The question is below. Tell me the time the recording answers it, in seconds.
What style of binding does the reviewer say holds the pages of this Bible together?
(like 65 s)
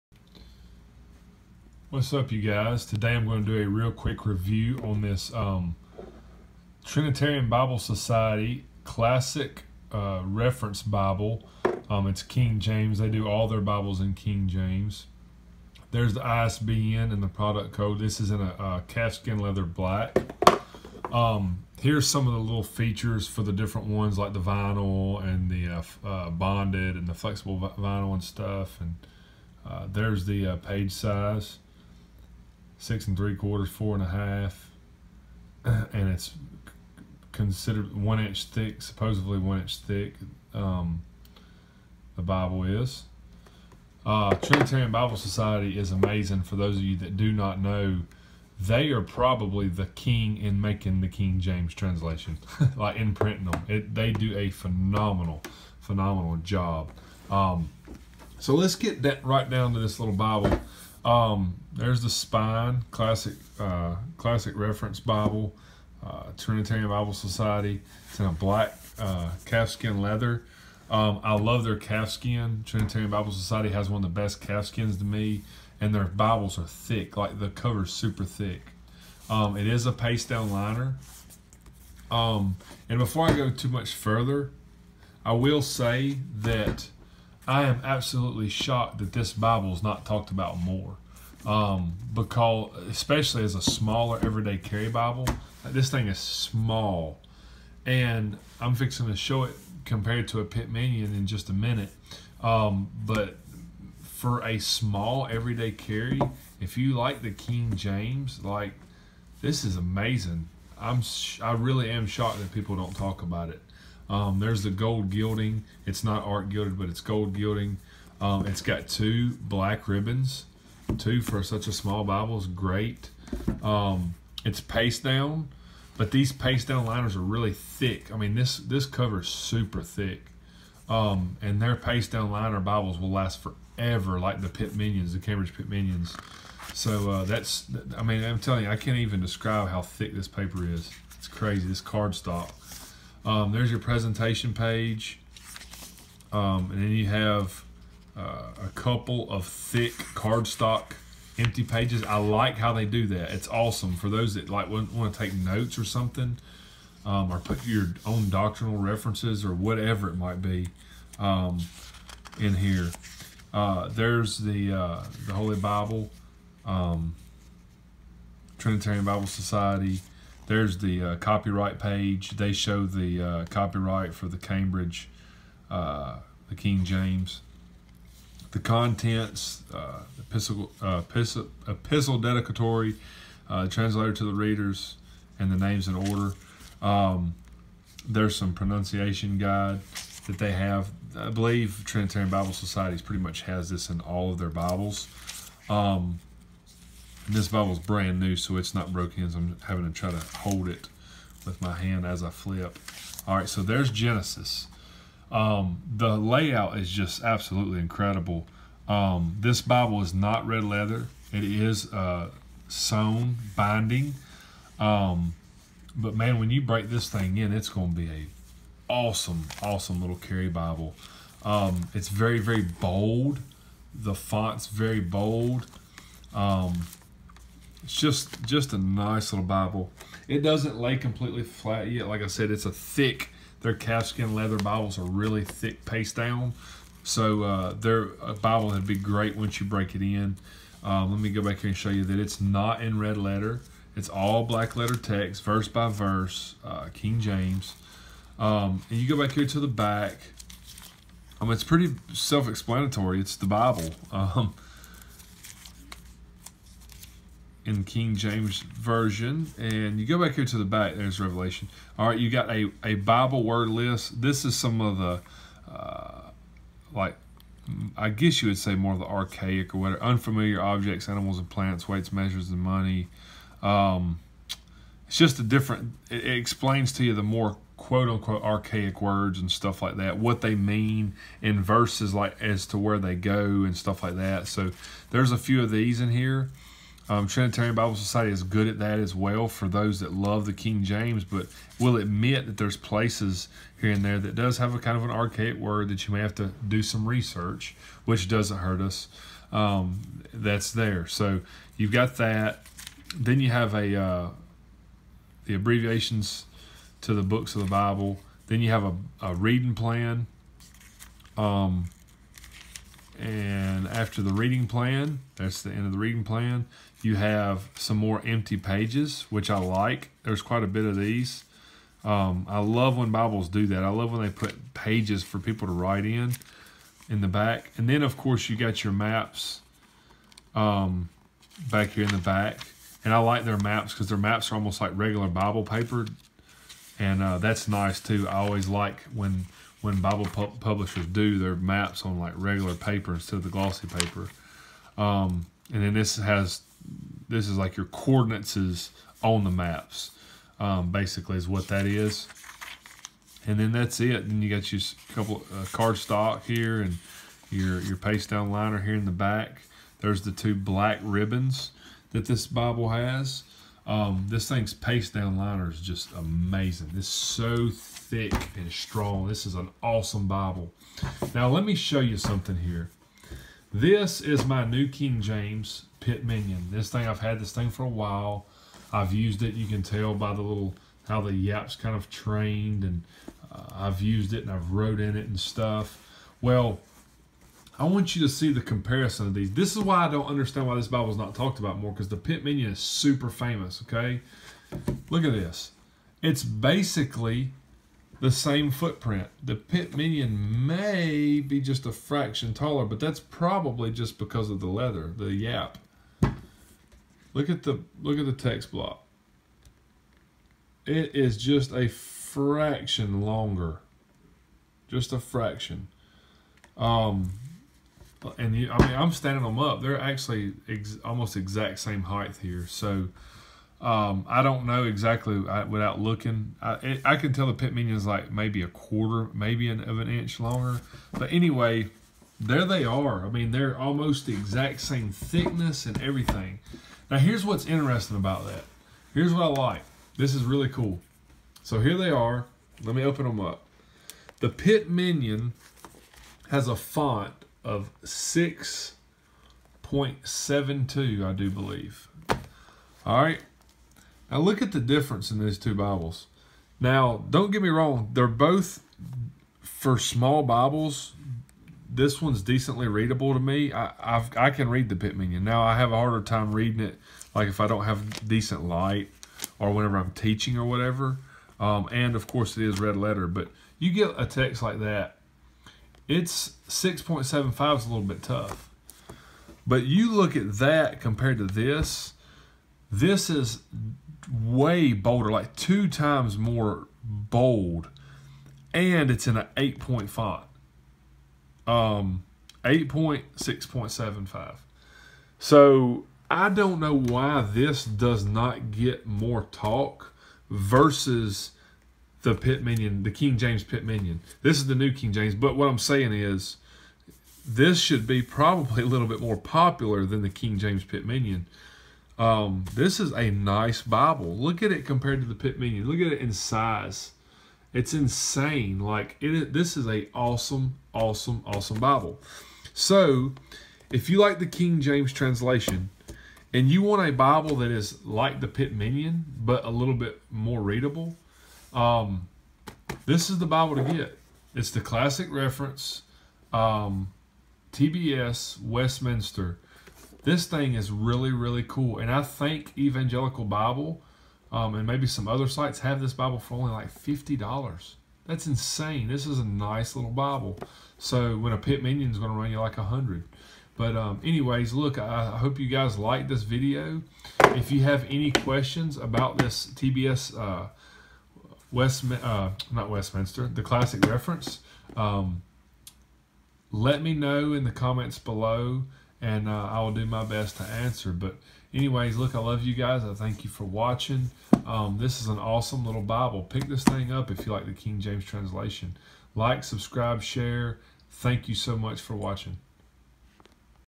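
212 s.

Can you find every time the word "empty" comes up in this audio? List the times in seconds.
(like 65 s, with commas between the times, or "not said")
151 s, 318 s.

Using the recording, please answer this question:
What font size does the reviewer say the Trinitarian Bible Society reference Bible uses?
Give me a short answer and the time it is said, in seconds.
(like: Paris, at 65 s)
8 point, at 489 s.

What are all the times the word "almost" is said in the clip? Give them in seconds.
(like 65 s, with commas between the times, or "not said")
334 s, 421 s, 433 s.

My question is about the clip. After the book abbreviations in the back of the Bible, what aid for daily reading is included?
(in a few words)
A reading plan.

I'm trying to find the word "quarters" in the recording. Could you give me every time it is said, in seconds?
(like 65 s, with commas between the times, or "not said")
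33 s, 428 s.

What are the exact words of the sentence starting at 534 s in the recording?
It's the classic reference, um, TBS Westminster.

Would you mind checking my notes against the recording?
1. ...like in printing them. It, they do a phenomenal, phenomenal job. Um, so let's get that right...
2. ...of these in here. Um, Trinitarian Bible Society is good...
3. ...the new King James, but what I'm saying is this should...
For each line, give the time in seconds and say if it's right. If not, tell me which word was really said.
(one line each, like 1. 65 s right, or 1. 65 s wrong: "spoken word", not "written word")
1. 52 s right
2. 285 s right
3. 504 s right.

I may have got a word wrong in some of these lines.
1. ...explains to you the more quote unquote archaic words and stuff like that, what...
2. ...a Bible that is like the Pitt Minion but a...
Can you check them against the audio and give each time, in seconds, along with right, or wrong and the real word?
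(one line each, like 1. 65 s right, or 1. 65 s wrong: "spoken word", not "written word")
1. 276 s right
2. 527 s right.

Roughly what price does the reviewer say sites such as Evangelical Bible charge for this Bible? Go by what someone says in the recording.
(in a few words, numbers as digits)
$50.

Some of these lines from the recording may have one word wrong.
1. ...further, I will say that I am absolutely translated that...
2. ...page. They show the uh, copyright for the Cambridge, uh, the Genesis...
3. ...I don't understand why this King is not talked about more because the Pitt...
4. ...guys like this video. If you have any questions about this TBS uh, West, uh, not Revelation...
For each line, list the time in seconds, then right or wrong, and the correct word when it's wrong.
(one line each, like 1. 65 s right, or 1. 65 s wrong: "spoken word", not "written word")
1. 83 s wrong: "shocked", not "translated"
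2. 171 s wrong: "King", not "Genesis"
3. 390 s wrong: "Bible", not "King"
4. 555 s wrong: "Westminster", not "Revelation".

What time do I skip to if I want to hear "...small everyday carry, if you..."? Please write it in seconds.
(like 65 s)
104 s.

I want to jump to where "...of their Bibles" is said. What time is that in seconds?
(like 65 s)
194 s.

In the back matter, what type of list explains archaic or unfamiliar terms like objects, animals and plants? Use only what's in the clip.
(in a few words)
Bible word list.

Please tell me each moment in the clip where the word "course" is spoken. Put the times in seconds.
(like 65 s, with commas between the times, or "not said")
328 s, 472 s.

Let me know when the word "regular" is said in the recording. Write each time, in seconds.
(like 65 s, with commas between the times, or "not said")
334 s, 342 s.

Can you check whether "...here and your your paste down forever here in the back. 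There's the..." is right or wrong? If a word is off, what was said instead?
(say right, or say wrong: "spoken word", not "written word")
wrong: "liner", not "forever".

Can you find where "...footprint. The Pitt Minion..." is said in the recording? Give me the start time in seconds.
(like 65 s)
398 s.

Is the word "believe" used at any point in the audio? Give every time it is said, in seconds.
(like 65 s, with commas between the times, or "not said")
191 s, 451 s.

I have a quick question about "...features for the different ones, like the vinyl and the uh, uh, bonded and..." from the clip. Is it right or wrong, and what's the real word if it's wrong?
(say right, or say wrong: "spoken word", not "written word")
right.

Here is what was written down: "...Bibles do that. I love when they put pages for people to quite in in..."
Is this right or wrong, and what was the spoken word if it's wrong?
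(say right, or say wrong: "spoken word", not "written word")
wrong: "write", not "quite".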